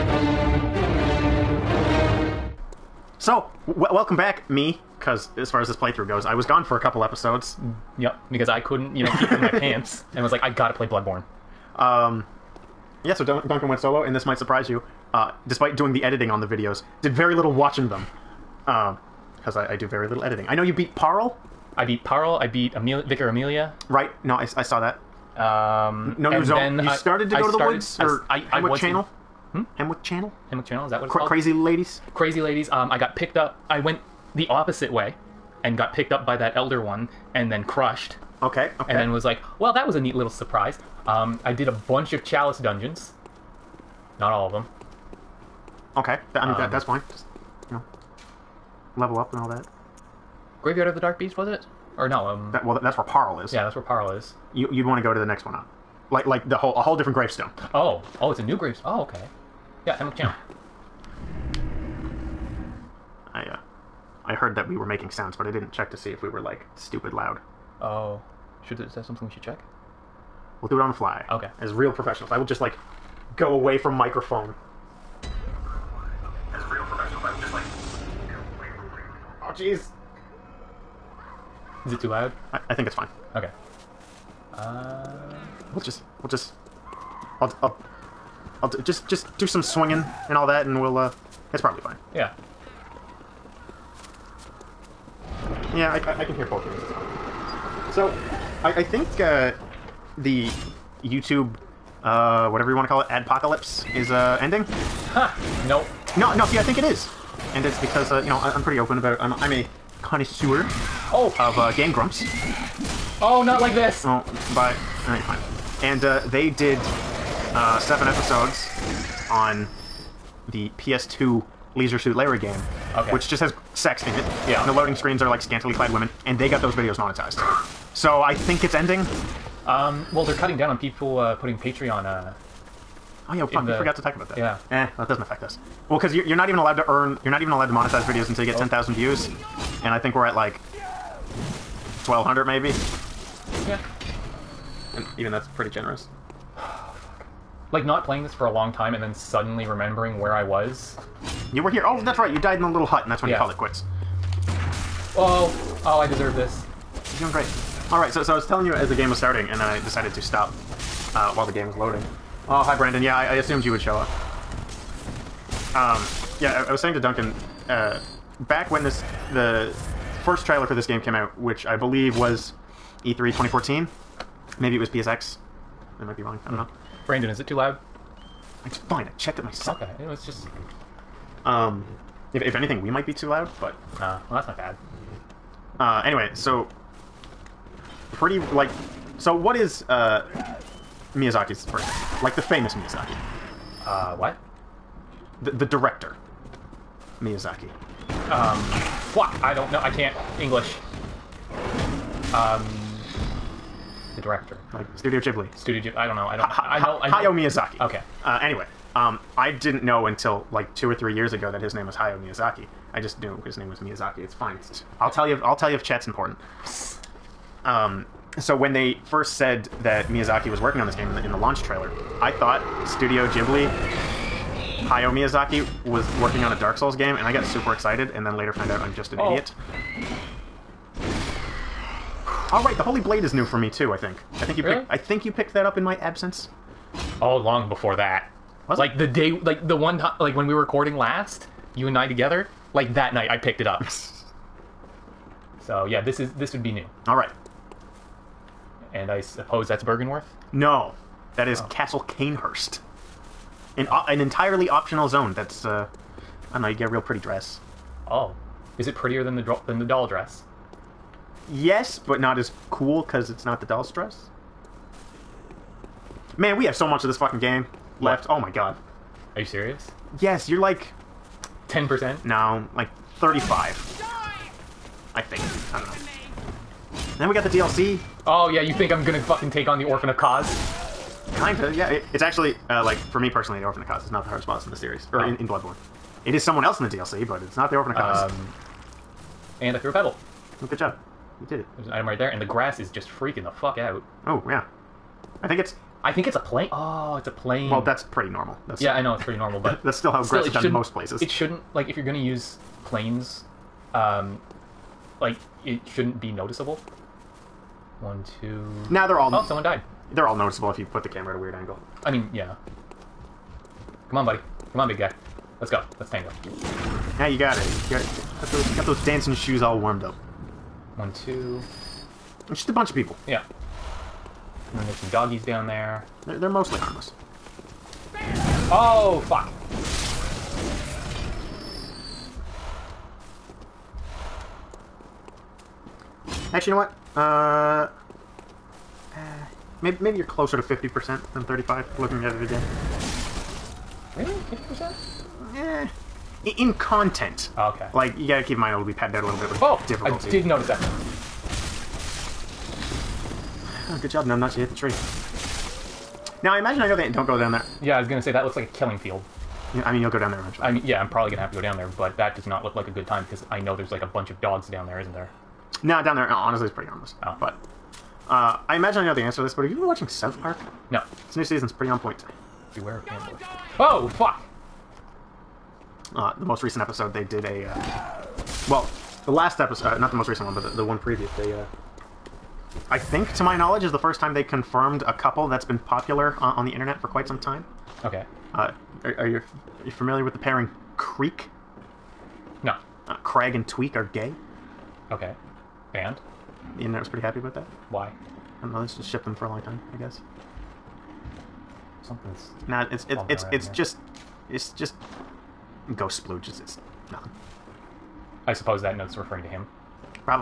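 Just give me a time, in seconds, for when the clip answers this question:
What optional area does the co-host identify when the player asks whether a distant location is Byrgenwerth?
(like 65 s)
251 s.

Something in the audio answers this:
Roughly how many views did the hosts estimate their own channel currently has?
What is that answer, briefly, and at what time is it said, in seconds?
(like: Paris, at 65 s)
1,200, at 140 s.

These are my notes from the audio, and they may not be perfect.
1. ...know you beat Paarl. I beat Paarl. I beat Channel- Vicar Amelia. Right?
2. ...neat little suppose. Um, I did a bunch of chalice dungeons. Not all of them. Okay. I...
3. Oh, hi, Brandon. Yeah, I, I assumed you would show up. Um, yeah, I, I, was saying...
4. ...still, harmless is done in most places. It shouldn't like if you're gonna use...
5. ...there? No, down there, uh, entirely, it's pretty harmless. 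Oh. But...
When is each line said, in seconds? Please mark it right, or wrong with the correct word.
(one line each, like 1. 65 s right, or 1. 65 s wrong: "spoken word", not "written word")
1. 20 s wrong: "Emil", not "Channel"
2. 39 s wrong: "surprise", not "suppose"
3. 162 s right
4. 300 s wrong: "grass", not "harmless"
5. 365 s wrong: "honestly", not "entirely".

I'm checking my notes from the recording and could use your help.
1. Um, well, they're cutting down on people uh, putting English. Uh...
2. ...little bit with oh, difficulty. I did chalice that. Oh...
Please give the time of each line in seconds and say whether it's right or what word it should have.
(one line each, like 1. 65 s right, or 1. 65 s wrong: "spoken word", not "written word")
1. 129 s wrong: "Patreon", not "English"
2. 349 s wrong: "notice", not "chalice".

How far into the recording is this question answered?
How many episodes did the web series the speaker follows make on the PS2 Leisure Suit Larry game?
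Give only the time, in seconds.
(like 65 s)
117 s.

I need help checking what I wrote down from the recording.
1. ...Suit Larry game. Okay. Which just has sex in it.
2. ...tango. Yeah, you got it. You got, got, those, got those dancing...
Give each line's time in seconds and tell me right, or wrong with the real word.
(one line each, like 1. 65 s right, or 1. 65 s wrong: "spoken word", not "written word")
1. 121 s right
2. 316 s right.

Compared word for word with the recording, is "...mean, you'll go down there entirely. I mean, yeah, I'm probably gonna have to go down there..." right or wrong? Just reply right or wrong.
wrong.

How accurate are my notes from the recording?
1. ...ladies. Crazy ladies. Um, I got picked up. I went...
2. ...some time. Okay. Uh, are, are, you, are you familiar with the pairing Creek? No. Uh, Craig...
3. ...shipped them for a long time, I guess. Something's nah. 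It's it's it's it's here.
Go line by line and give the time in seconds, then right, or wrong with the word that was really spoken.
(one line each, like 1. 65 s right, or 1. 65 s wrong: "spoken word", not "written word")
1. 31 s right
2. 387 s right
3. 399 s right.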